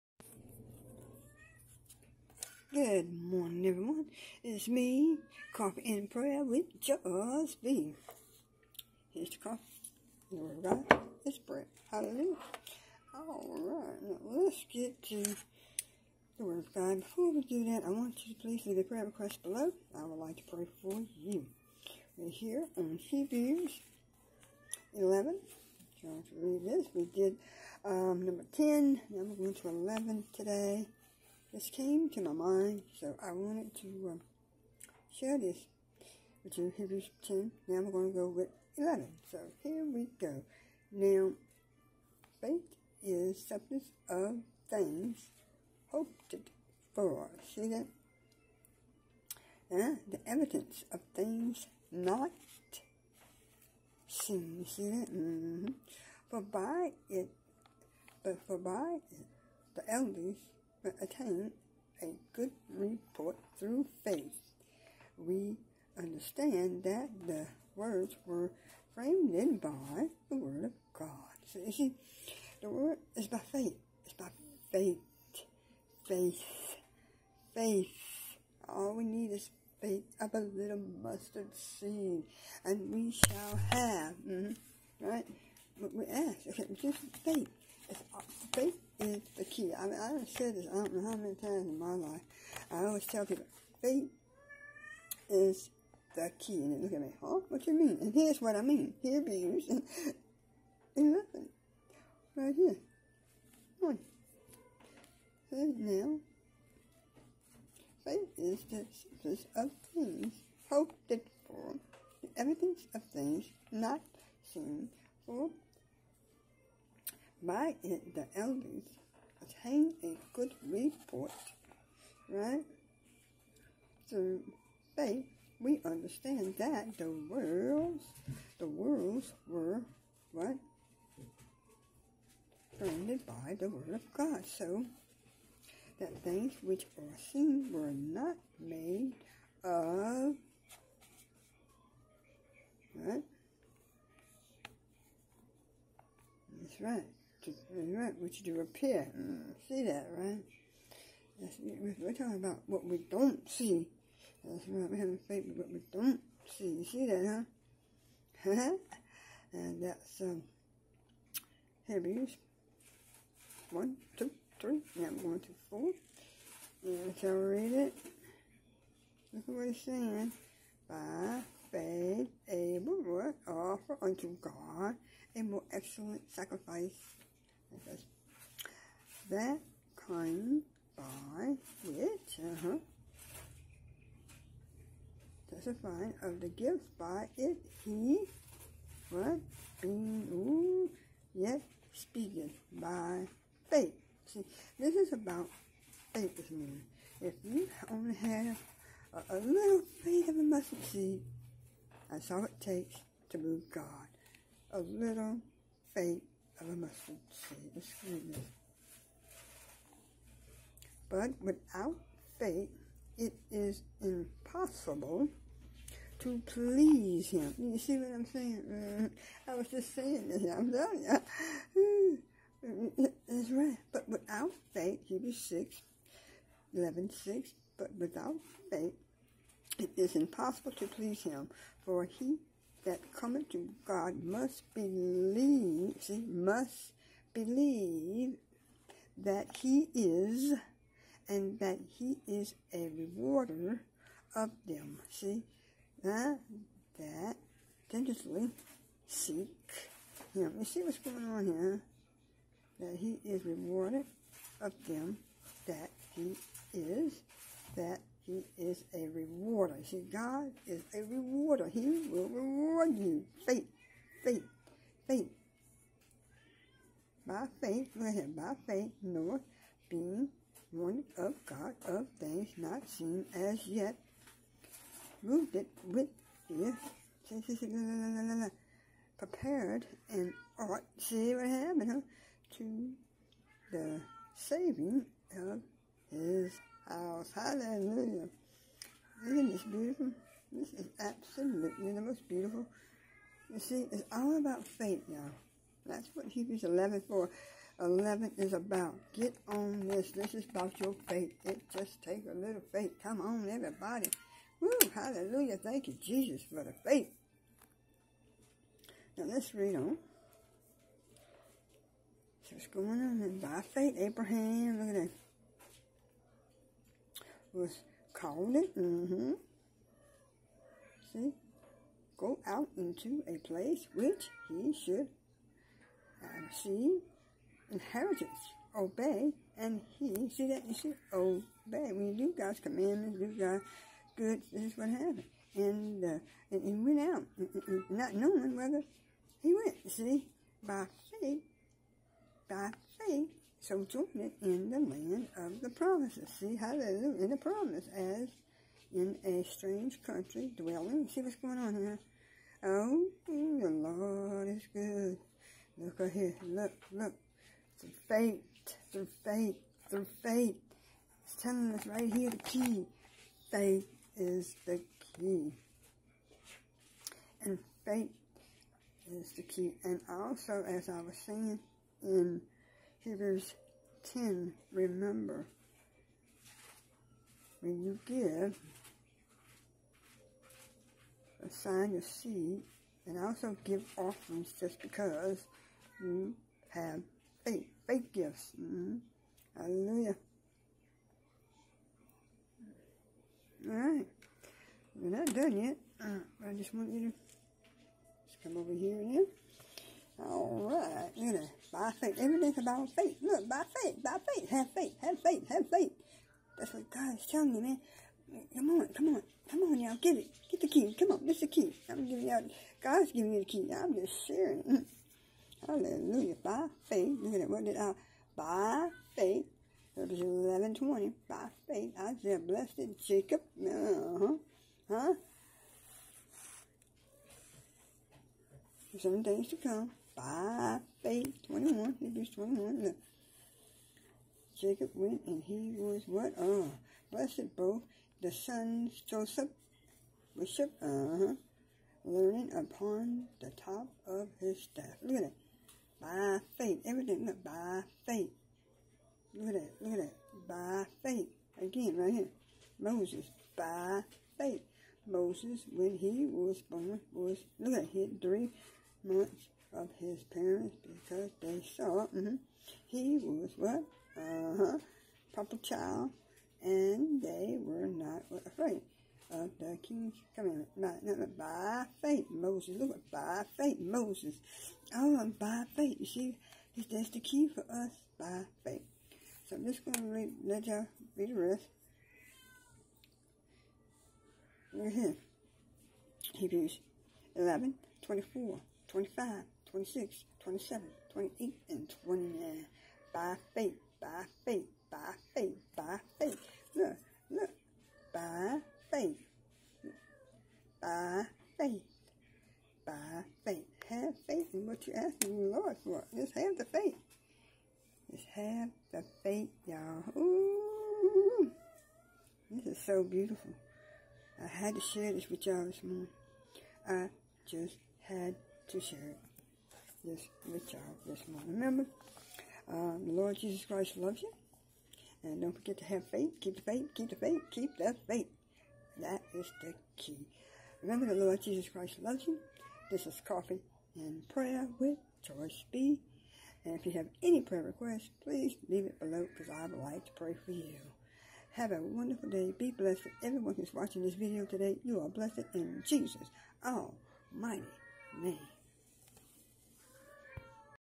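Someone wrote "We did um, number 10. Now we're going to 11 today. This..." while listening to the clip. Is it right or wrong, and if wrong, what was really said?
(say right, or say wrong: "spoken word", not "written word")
right.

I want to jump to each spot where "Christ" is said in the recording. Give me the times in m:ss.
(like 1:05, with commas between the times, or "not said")
8:43, 8:51.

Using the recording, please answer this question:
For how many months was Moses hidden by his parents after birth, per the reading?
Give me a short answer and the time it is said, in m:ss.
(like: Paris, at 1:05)
3, at 7:38.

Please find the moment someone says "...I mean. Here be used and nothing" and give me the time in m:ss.
1:38.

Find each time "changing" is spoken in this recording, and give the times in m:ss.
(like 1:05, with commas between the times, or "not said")
not said.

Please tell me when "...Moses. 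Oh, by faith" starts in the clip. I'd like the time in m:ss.
7:53.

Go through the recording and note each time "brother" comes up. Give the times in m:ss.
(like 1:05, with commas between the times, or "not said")
not said.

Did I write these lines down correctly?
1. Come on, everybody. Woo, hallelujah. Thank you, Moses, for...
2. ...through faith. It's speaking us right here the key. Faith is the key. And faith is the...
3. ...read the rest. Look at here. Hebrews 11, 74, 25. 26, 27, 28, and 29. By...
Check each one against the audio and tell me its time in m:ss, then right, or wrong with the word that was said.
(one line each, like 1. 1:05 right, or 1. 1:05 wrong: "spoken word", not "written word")
1. 5:03 wrong: "Jesus", not "Moses"
2. 5:59 wrong: "telling", not "speaking"
3. 8:01 wrong: "24", not "74".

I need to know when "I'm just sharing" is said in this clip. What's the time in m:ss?
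6:53.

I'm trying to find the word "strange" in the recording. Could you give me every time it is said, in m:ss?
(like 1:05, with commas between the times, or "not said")
5:49.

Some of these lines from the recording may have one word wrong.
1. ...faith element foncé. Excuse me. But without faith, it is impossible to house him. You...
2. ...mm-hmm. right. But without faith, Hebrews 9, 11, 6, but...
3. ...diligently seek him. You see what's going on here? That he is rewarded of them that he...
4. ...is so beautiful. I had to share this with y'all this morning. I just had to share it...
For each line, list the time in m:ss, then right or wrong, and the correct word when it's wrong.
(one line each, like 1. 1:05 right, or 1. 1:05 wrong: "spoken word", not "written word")
1. 3:25 wrong: "please", not "house"
2. 3:43 wrong: "6", not "9"
3. 4:07 right
4. 8:32 right.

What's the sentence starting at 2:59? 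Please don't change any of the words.
That came by which, uh-huh, testifying of the gifts by it, he, what, being, ooh, yet speaking by faith.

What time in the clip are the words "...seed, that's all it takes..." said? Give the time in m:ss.
3:20.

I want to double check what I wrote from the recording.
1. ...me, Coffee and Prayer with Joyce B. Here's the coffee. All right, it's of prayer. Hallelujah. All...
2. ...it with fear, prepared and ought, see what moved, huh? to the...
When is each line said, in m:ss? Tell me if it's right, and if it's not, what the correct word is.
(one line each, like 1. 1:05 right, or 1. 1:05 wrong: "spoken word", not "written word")
1. 0:04 right
2. 4:35 wrong: "happened", not "moved".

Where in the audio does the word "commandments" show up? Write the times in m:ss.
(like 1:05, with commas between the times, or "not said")
5:32, 7:50.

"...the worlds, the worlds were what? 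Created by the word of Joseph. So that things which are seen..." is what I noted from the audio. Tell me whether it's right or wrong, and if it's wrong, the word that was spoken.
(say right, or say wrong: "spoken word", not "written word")
wrong: "God", not "Joseph".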